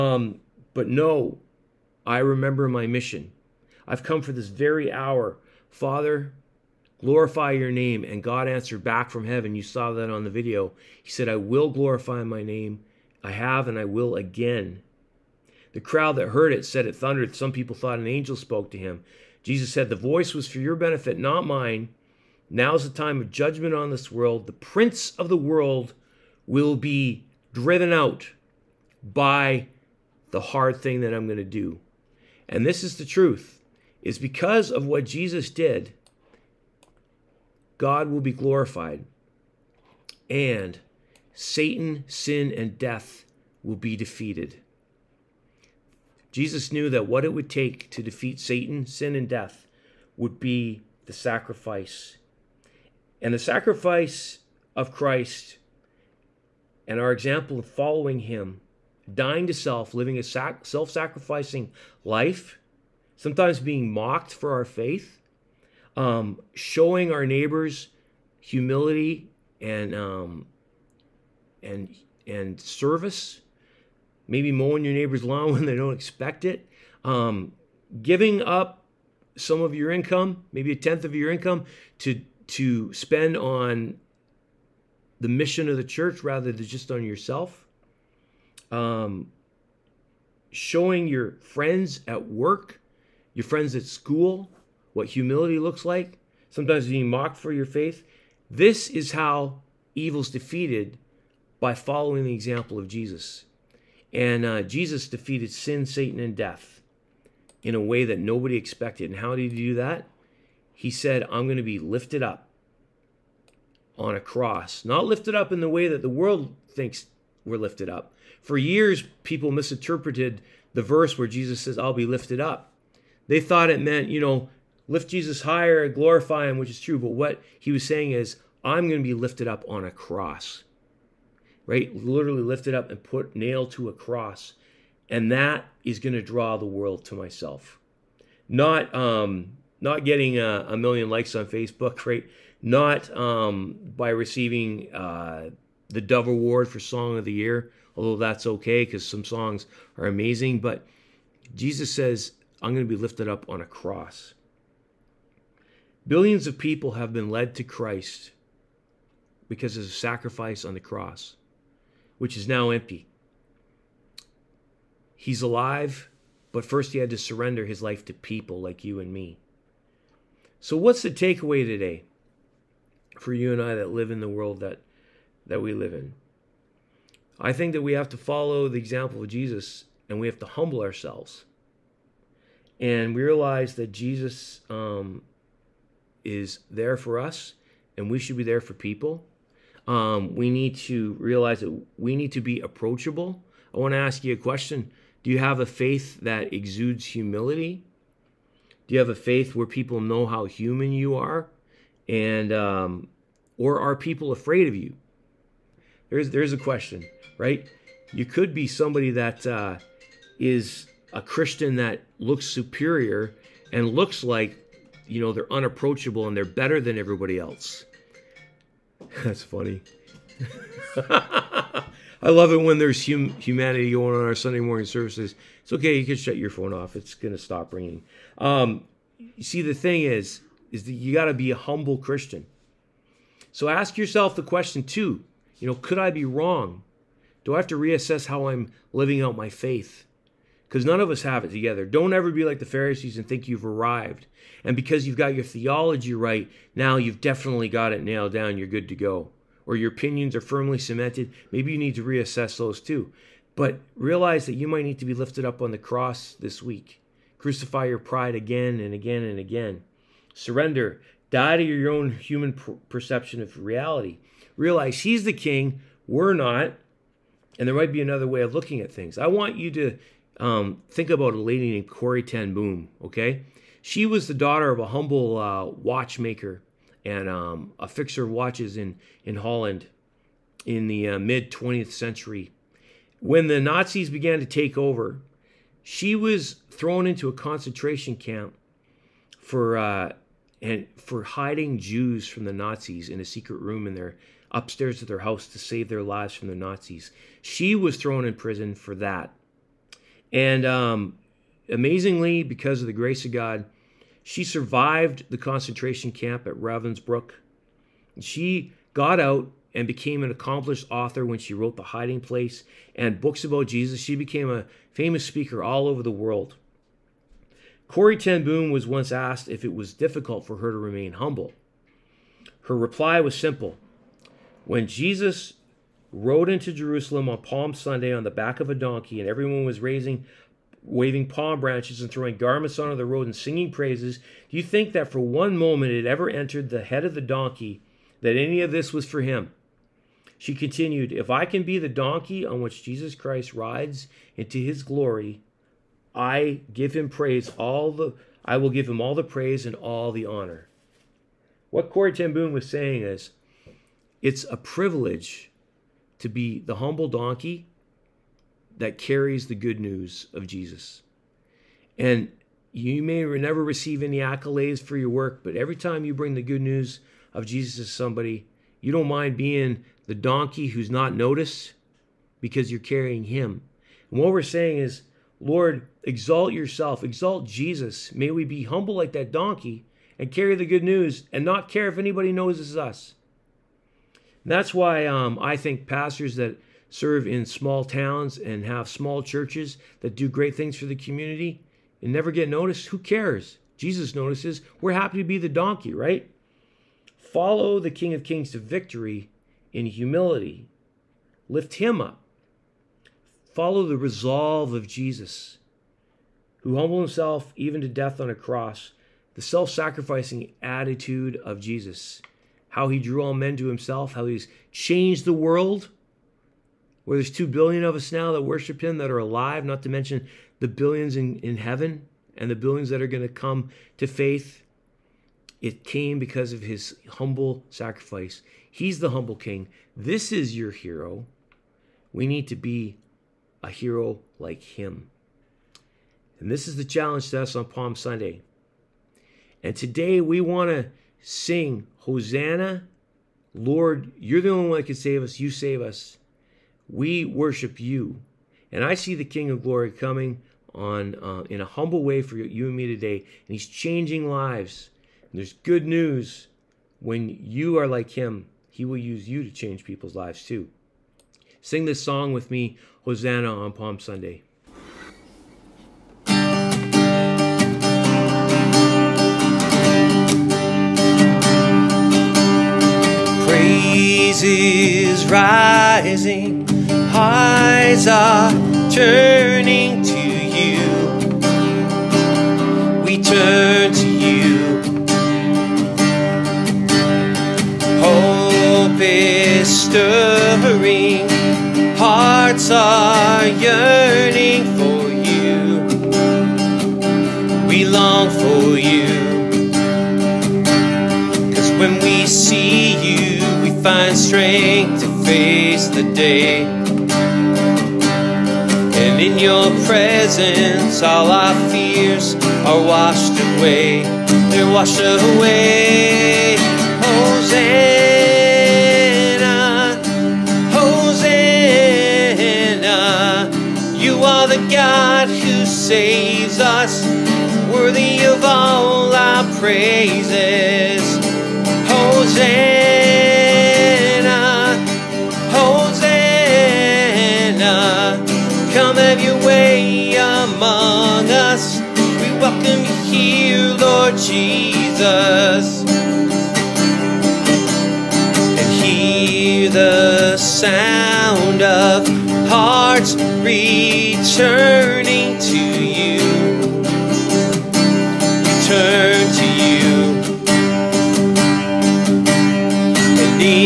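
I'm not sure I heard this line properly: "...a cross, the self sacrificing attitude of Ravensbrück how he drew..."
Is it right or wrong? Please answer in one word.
wrong.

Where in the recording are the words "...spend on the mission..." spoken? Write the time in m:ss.
1:22.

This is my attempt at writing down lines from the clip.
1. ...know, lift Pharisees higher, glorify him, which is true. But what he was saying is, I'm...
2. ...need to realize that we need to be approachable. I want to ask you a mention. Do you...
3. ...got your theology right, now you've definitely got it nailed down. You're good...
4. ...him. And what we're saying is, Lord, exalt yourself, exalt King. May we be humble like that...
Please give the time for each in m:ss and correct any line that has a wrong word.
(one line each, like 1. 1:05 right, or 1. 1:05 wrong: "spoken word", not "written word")
1. 2:04 wrong: "Jesus", not "Pharisees"
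2. 3:10 wrong: "question", not "mention"
3. 4:05 right
4. 6:13 wrong: "Jesus", not "King".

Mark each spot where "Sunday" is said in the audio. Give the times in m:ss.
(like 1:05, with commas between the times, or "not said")
3:44, 5:27, 7:17, 7:43.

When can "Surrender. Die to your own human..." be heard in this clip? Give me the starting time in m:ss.
4:20.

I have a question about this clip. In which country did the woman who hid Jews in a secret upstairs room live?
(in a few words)
Holland.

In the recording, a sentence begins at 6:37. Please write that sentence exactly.
Follow the King of Kings to victory in humility.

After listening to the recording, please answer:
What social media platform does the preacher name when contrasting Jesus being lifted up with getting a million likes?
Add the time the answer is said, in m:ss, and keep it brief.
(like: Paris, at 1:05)
Facebook, at 2:21.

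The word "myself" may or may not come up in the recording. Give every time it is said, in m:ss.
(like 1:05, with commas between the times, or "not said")
2:17.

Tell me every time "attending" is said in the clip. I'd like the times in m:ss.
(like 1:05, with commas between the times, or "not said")
not said.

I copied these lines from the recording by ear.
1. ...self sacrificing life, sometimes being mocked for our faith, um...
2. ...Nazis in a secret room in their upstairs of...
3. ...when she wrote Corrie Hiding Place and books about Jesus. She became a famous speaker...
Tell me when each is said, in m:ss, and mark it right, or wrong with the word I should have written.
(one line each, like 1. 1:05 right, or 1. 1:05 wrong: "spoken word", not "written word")
1. 1:00 right
2. 4:52 right
3. 5:11 wrong: "The", not "Corrie".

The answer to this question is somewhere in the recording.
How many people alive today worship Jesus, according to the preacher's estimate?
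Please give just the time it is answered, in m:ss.
6:57.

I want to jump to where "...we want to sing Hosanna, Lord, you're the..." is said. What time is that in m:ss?
7:20.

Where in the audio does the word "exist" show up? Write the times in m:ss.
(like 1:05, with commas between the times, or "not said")
not said.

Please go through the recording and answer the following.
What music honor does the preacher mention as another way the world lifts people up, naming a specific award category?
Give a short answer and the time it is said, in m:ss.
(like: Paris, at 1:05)
Dove Award for Song of the Year, at 2:26.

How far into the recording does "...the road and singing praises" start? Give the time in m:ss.
5:32.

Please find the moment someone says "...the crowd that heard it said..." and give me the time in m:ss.
0:15.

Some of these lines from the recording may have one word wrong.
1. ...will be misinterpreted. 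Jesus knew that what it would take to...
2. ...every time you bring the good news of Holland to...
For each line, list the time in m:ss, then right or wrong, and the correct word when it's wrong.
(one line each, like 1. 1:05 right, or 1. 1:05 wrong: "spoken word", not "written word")
1. 0:43 wrong: "defeated", not "misinterpreted"
2. 6:05 wrong: "Jesus", not "Holland".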